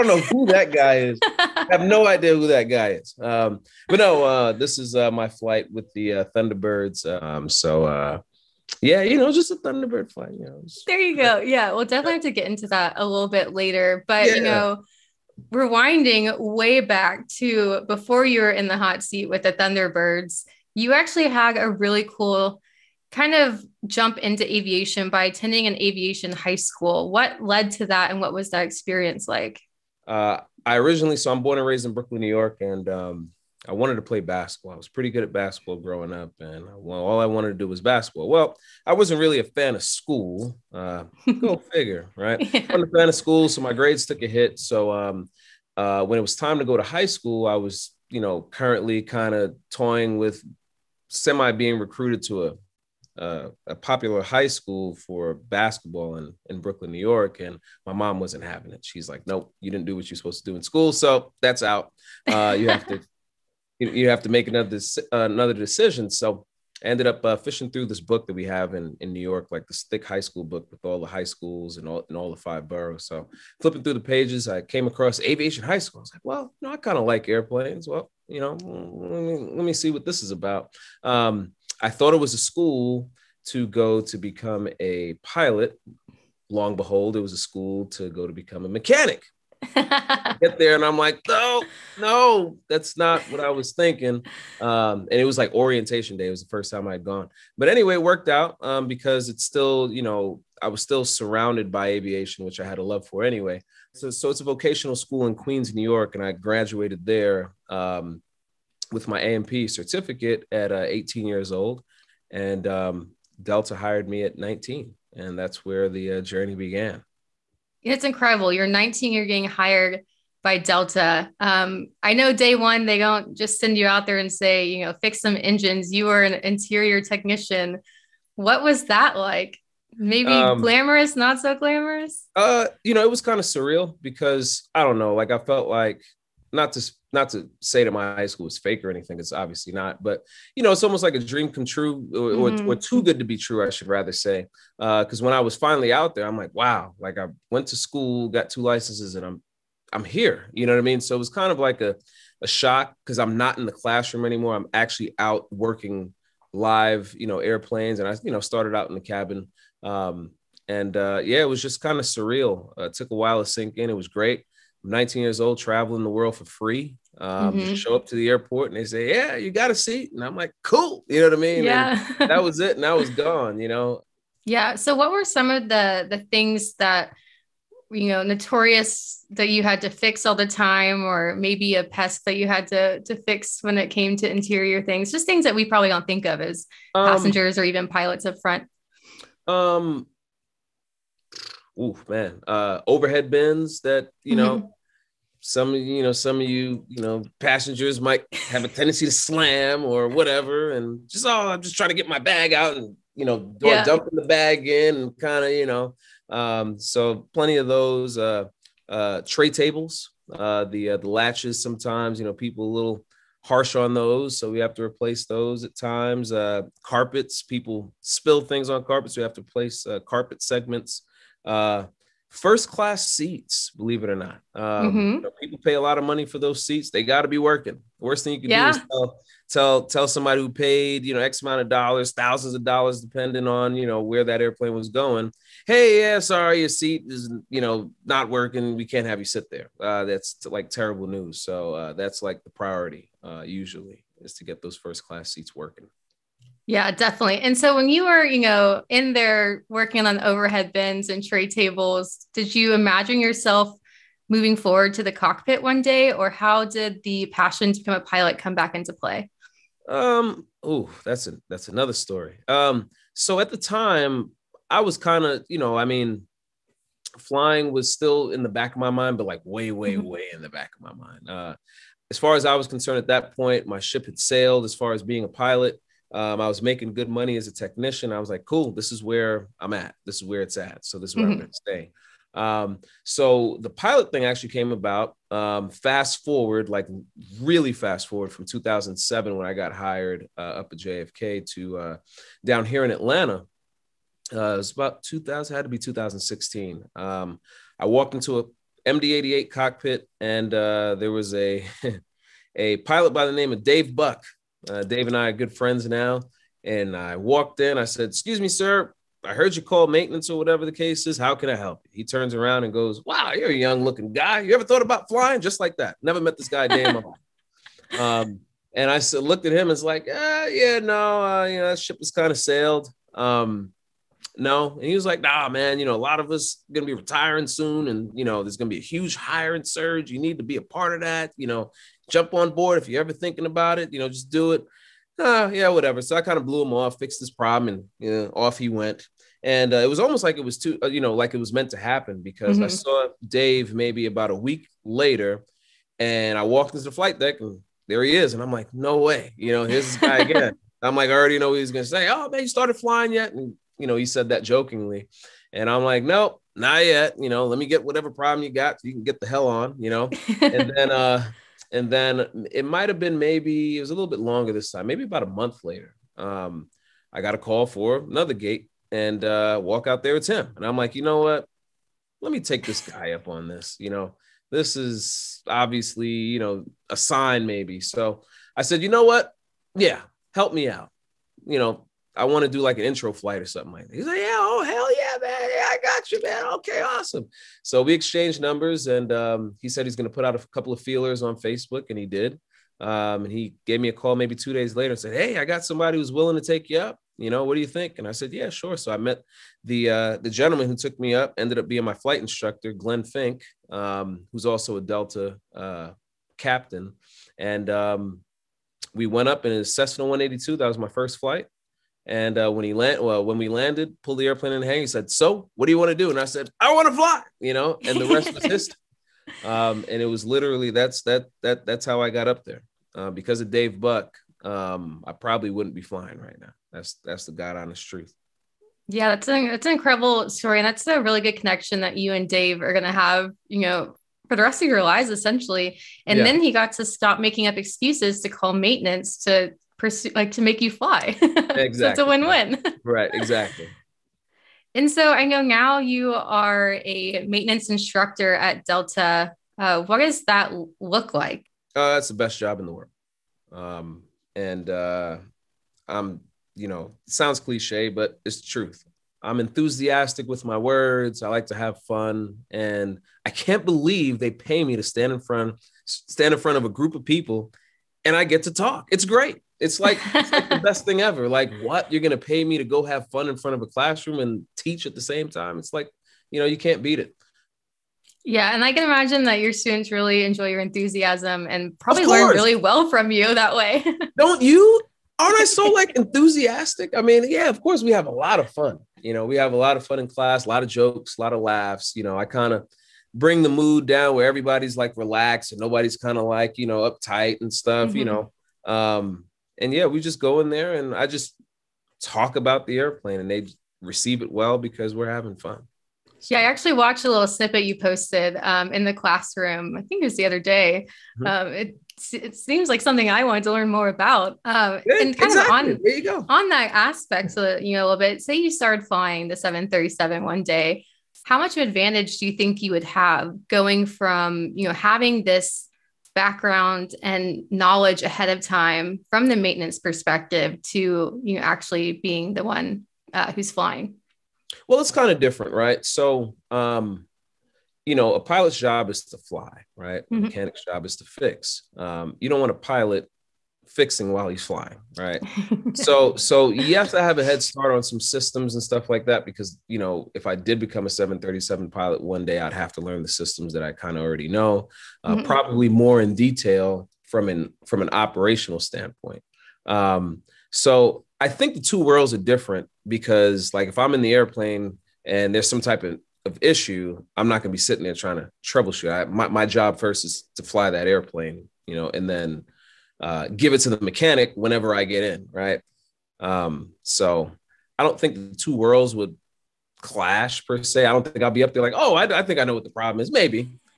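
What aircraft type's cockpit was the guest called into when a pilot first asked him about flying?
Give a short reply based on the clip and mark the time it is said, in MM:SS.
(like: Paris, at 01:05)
MD-88, at 04:58.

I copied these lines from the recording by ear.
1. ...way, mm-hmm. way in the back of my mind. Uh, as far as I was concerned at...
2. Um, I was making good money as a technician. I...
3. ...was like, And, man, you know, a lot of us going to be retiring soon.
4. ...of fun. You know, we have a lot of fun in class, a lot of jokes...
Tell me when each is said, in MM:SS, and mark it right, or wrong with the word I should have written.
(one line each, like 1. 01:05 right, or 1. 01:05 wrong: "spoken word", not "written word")
1. 04:29 right
2. 04:36 right
3. 05:24 wrong: "Nah", not "And"
4. 08:08 right.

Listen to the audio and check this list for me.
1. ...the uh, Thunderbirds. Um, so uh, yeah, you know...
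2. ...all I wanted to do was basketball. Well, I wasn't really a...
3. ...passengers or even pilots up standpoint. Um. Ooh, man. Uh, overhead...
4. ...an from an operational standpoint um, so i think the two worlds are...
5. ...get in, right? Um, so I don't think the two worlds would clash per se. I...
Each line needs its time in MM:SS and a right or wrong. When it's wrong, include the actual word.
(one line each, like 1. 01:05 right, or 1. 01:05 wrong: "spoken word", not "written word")
1. 00:05 right
2. 00:37 right
3. 03:07 wrong: "front", not "standpoint"
4. 09:17 right
5. 09:34 right.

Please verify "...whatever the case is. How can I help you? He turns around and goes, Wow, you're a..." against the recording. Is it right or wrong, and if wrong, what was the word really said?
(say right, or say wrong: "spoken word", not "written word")
right.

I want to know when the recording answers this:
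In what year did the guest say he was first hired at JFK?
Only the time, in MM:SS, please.
04:48.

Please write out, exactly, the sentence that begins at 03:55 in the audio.
Hey, yeah, sorry, your seat is you know not working.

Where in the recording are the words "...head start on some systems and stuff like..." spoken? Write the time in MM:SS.
09:07.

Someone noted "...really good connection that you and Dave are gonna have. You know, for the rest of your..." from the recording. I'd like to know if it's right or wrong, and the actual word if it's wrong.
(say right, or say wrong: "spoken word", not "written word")
right.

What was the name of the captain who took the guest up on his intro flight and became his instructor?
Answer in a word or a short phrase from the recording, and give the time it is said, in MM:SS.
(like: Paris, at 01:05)
Glenn Fink, at 06:42.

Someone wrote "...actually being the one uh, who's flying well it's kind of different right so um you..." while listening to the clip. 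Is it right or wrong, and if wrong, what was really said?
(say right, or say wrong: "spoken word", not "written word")
right.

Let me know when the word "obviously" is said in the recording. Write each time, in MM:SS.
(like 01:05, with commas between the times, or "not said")
02:19, 06:15.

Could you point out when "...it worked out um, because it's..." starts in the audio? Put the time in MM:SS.
01:37.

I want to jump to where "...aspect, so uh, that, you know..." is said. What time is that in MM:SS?
08:36.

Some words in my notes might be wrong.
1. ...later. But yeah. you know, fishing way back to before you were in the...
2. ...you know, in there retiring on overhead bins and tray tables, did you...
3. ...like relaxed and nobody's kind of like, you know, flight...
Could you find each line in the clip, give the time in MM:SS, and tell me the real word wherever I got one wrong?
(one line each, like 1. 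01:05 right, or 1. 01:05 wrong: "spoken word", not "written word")
1. 00:13 wrong: "rewinding", not "fishing"
2. 04:08 wrong: "working", not "retiring"
3. 08:14 wrong: "uptight", not "flight".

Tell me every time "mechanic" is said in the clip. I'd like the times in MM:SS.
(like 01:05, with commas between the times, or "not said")
01:28, 09:00, 09:33.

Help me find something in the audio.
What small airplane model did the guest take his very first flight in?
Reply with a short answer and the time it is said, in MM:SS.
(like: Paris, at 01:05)
Cessna 182, at 06:49.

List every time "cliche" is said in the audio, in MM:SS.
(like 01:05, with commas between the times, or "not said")
07:37.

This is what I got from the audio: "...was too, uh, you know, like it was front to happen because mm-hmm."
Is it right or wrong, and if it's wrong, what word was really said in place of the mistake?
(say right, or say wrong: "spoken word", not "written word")
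wrong: "meant", not "front".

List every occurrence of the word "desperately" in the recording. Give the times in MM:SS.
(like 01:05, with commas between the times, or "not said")
not said.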